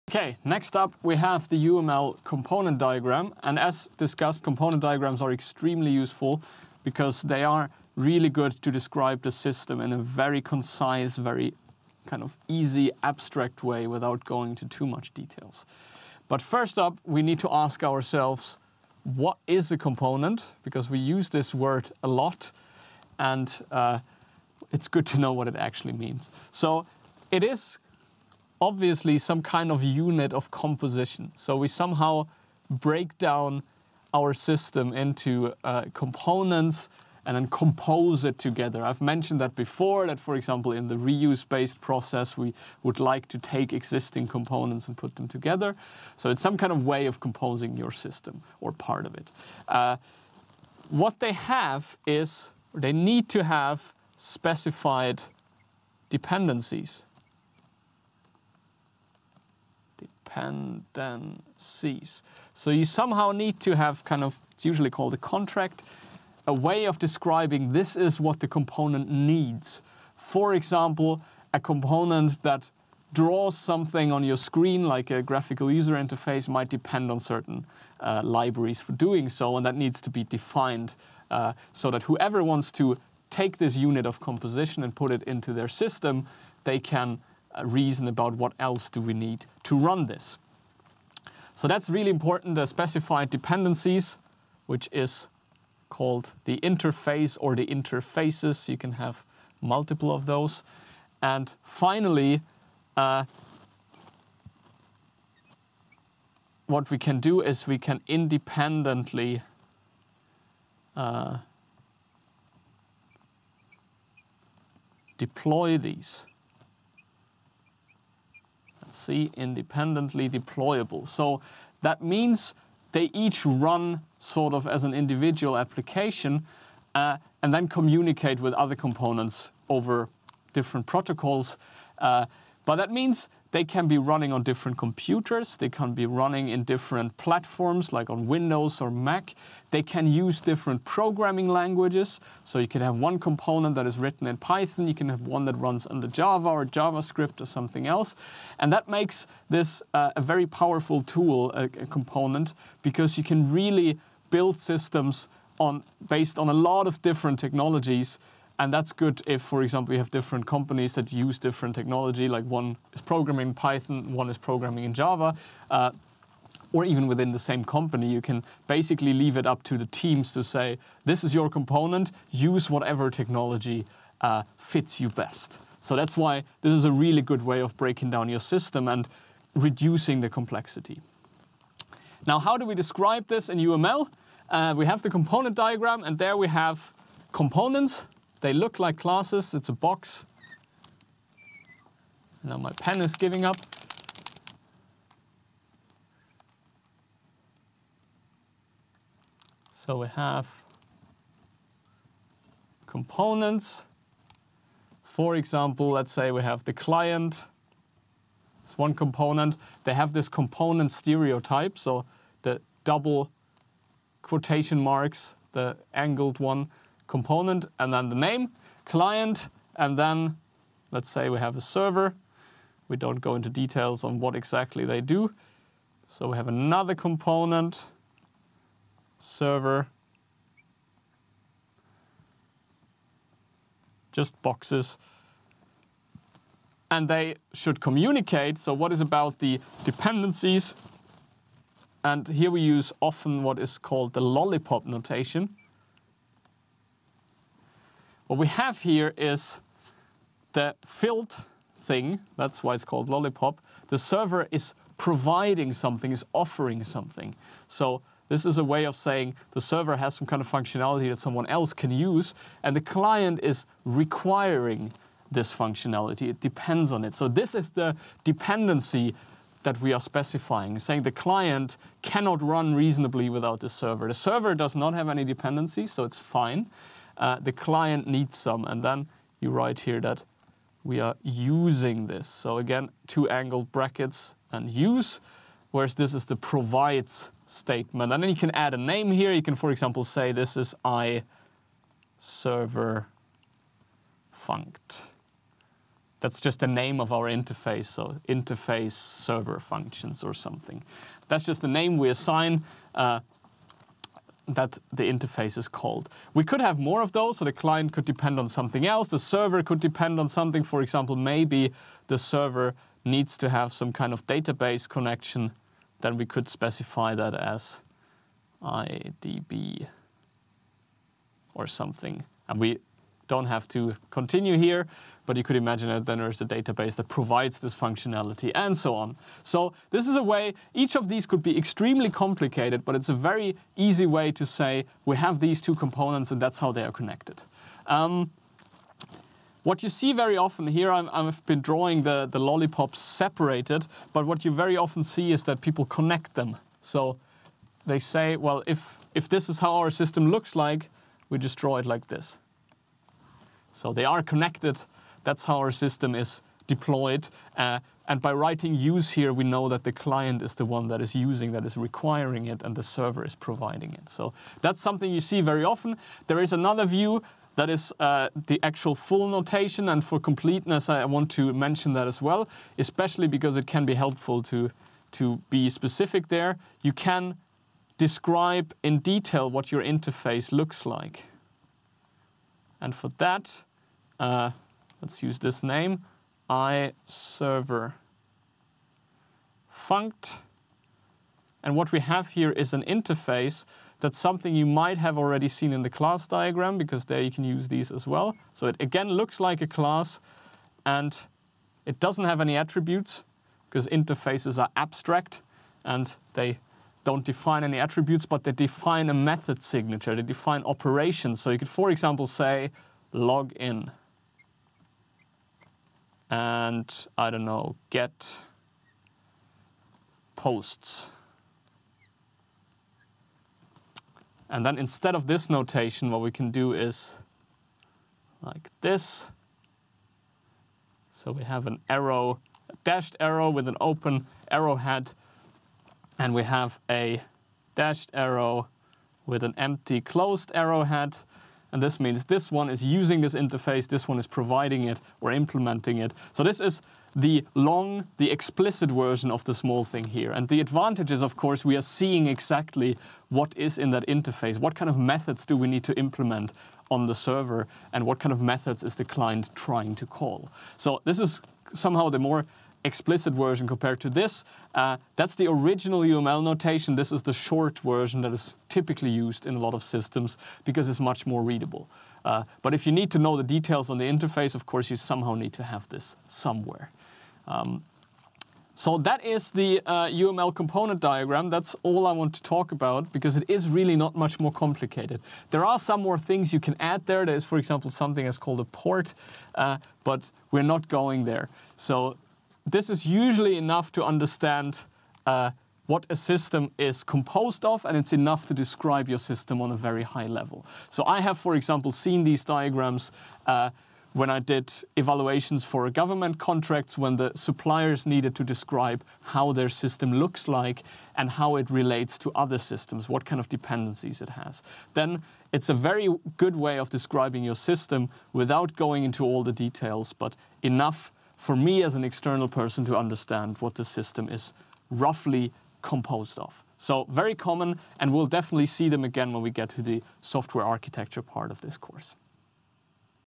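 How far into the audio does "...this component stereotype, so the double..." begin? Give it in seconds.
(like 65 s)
210 s.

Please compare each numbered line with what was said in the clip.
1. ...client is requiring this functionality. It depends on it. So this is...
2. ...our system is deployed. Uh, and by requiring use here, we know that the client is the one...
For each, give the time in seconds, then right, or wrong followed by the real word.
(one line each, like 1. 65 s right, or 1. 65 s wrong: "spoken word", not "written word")
1. 262 s right
2. 355 s wrong: "writing", not "requiring".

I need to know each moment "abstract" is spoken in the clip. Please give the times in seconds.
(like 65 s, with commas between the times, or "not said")
13 s, 404 s.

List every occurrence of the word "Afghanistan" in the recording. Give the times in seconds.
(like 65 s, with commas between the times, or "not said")
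not said.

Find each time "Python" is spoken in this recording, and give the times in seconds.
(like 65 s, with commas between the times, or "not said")
144 s, 163 s.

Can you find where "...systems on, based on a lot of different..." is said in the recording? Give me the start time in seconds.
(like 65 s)
154 s.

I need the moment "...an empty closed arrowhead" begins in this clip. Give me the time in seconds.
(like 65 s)
439 s.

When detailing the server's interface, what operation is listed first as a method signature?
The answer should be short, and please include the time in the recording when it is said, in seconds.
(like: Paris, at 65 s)
Log in, at 413 s.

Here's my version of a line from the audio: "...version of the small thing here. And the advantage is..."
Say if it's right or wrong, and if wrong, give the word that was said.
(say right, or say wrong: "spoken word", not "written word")
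right.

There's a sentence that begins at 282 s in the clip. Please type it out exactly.
So again, two angled brackets and use, whereas this is the provides statement.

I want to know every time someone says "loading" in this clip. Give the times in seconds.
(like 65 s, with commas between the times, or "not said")
not said.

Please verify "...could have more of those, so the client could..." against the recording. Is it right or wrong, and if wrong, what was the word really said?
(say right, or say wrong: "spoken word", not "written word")
right.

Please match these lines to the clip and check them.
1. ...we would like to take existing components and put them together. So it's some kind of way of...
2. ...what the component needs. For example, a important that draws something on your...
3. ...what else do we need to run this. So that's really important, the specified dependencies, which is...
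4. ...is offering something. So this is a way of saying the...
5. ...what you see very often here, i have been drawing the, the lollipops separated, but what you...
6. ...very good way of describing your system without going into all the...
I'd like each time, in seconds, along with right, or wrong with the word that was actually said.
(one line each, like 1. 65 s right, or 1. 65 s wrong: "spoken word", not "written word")
1. 42 s right
2. 68 s wrong: "component", not "important"
3. 88 s right
4. 256 s right
5. 339 s right
6. 515 s right.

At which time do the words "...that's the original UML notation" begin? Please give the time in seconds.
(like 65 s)
465 s.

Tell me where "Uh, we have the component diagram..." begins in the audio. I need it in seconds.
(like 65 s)
184 s.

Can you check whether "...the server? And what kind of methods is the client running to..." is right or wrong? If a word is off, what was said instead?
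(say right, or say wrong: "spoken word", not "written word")
wrong: "trying", not "running".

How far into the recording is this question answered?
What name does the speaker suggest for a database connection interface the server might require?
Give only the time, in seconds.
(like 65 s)
318 s.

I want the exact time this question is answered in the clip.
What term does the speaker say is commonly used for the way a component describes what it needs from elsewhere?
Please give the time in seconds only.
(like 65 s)
65 s.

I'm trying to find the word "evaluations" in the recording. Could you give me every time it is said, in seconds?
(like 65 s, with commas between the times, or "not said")
504 s.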